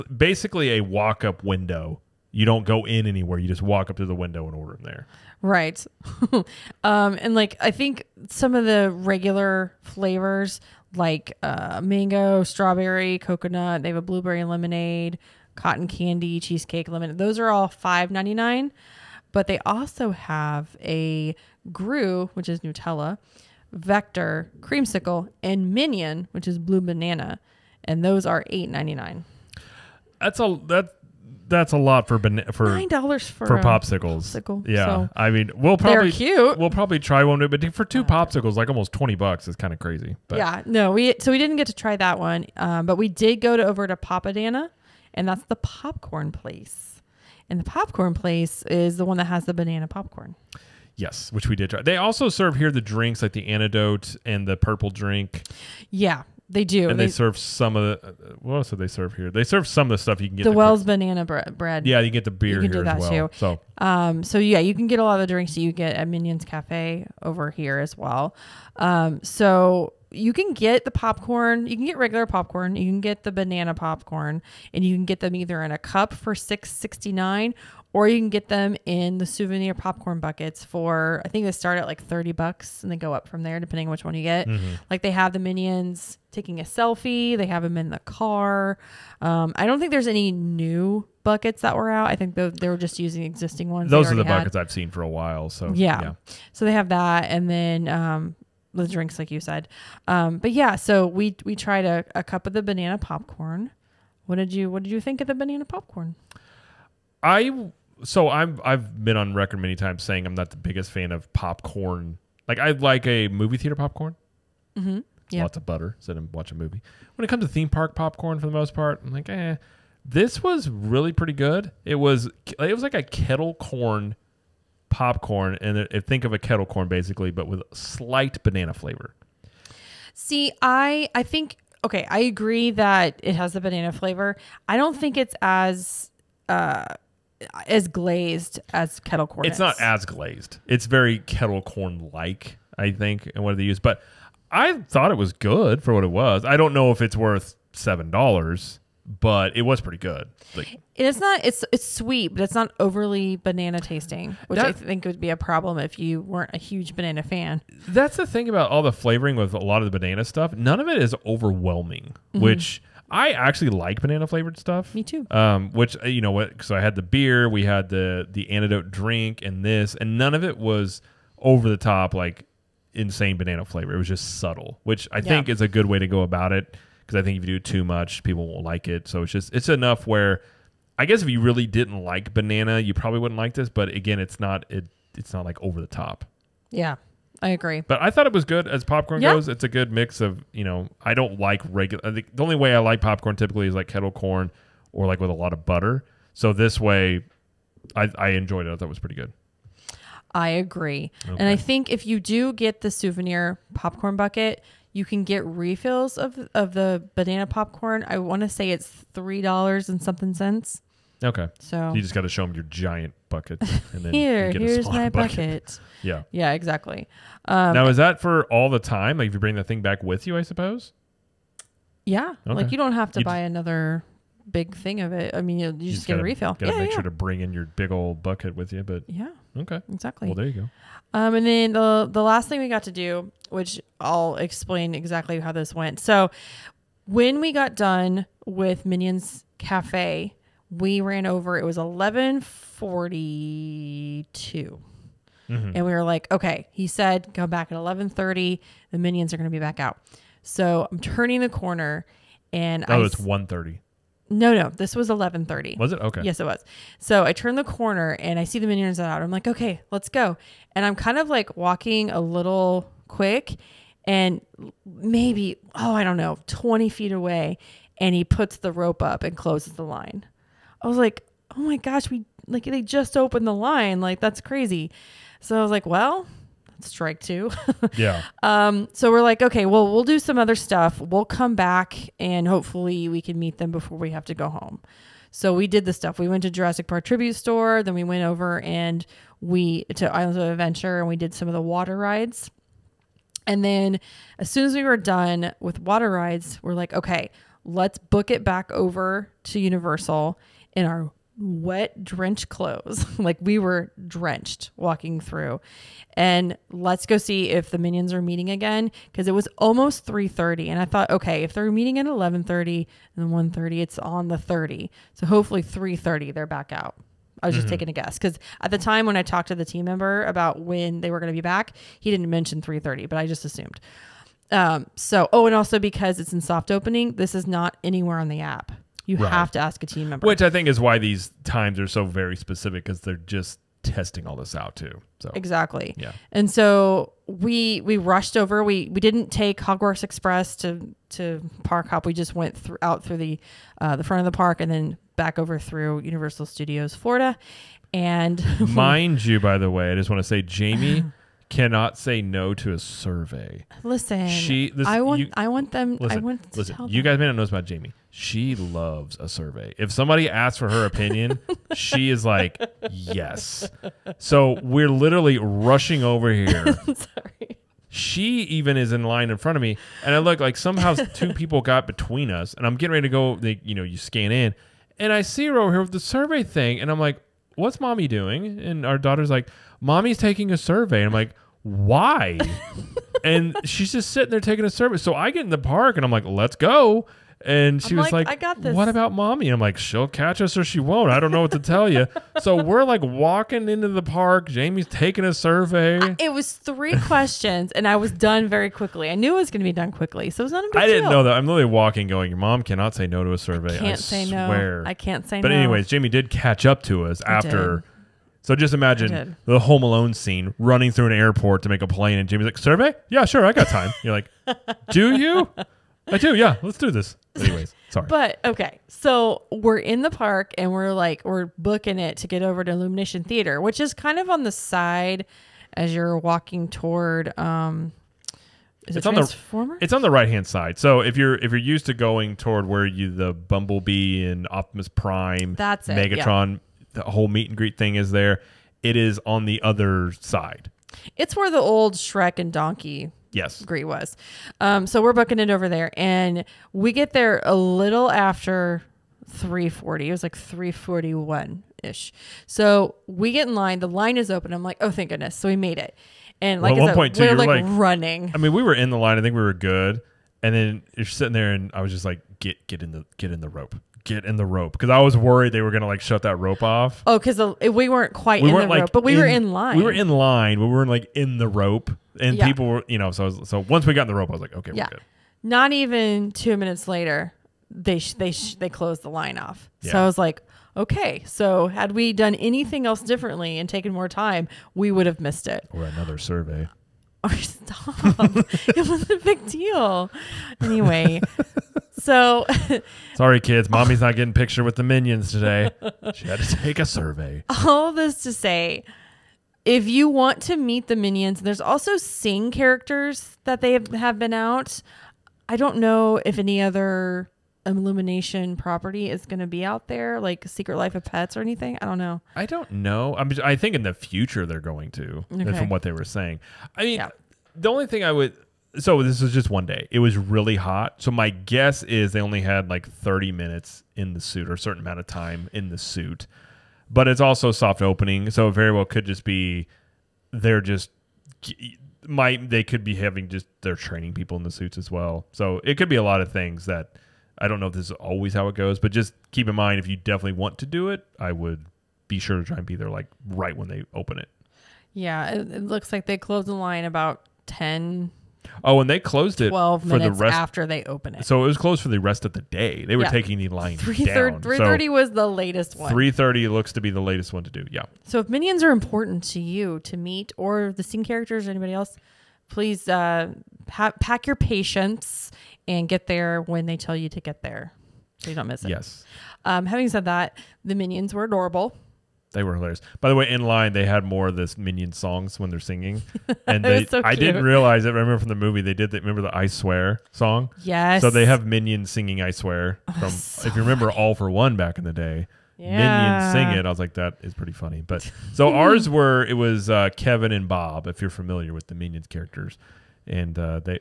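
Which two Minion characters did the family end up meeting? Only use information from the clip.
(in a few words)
Kevin and Bob.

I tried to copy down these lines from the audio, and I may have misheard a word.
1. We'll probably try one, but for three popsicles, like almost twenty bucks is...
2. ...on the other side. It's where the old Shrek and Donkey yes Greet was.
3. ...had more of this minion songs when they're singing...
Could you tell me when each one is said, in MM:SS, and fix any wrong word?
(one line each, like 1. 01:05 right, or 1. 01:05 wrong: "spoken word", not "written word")
1. 00:36 wrong: "two", not "three"
2. 07:19 right
3. 09:33 right.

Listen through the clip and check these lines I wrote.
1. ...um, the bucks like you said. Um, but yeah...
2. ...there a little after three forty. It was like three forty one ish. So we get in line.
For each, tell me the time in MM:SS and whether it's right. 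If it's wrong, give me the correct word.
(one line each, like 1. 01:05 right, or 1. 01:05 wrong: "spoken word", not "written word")
1. 01:37 wrong: "drinks", not "bucks"
2. 07:27 right.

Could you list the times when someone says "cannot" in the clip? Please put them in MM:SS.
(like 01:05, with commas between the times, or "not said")
05:51, 06:42.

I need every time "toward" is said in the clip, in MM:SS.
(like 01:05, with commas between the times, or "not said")
07:06, 07:12.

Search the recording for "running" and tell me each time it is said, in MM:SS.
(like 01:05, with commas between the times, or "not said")
06:50, 07:37.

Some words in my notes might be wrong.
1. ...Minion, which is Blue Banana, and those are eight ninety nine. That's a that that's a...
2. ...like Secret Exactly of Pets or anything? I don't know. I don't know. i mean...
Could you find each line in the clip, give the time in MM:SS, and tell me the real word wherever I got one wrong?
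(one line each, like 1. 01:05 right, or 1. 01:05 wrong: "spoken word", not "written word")
1. 00:25 right
2. 08:30 wrong: "Life", not "Exactly".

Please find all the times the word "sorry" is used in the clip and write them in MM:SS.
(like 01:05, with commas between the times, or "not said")
06:06, 06:57, 08:13.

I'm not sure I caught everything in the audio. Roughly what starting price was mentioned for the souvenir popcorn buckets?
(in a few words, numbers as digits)
$30.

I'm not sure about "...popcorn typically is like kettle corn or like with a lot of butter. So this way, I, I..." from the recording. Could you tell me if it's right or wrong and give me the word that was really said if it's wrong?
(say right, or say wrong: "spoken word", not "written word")
right.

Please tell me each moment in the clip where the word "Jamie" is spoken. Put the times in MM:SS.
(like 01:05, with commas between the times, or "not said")
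05:50, 05:57, 06:34, 06:45, 06:52.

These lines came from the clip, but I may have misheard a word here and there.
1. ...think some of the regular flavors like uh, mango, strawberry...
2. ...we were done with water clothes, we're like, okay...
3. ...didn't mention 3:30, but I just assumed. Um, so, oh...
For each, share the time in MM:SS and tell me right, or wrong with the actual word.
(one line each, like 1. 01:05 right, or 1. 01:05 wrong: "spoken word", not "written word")
1. 00:07 right
2. 04:54 wrong: "rides", not "clothes"
3. 05:22 right.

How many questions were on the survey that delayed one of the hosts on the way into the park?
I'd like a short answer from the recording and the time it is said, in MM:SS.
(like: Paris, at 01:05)
3, at 06:36.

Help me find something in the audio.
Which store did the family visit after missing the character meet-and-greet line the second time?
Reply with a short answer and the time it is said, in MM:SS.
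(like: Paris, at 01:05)
Jurassic Park Tribute Store, at 04:46.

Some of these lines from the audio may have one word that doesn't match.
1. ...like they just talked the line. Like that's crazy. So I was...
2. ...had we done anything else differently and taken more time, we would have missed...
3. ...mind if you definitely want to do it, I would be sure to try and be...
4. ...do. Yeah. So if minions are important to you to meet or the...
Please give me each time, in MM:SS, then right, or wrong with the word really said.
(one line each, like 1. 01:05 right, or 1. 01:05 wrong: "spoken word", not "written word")
1. 04:32 wrong: "opened", not "talked"
2. 08:01 right
3. 08:59 right
4. 09:17 right.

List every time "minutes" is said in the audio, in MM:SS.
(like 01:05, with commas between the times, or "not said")
07:56, 08:43.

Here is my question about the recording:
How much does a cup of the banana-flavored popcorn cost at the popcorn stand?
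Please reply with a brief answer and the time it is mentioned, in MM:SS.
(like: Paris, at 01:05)
$6.69, at 01:16.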